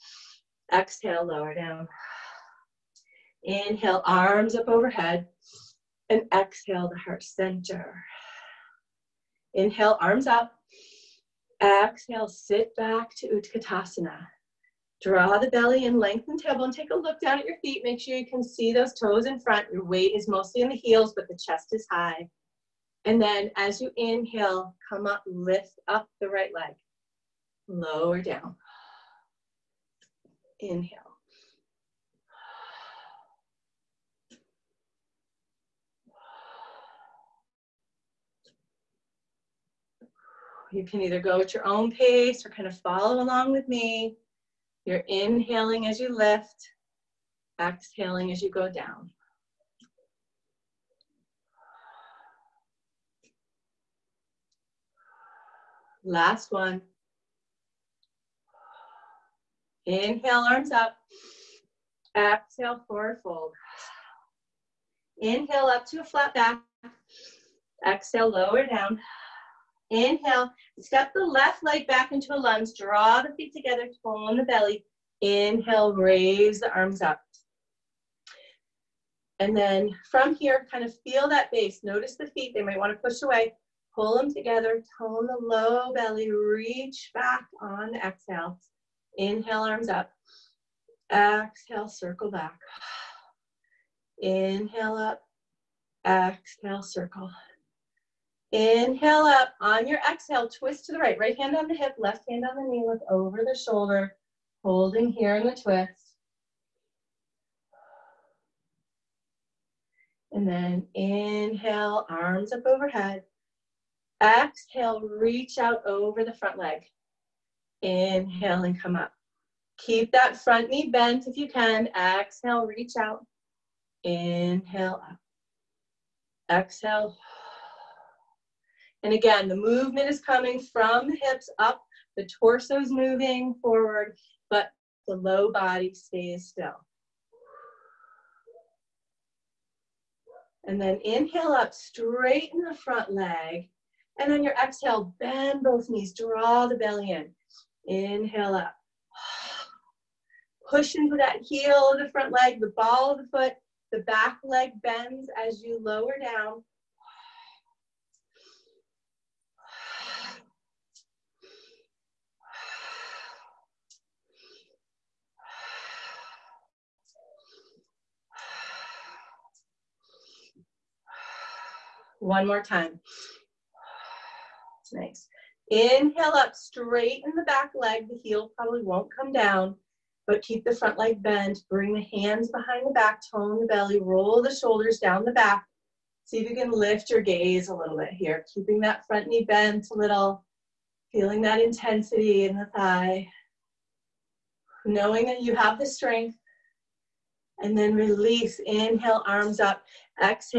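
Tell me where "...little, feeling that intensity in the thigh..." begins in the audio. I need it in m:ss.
3:09.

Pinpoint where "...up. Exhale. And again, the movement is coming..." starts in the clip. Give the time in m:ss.
2:05.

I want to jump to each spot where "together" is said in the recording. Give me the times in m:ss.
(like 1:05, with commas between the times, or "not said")
1:13, 1:24.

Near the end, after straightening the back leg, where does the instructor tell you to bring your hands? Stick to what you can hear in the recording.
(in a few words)
Behind the back.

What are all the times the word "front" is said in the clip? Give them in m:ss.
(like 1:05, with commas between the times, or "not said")
0:19, 1:56, 2:00, 2:22, 2:32, 3:00, 3:09.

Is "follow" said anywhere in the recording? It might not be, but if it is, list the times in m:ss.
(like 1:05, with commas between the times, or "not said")
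0:42.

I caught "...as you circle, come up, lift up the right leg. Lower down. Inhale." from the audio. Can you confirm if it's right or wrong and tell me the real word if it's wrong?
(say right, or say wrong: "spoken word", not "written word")
wrong: "inhale", not "circle".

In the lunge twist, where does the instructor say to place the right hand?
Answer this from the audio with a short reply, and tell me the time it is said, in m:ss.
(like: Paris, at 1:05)
On the hip, at 1:41.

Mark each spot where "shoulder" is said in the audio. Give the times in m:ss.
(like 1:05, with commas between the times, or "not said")
1:43, 3:04.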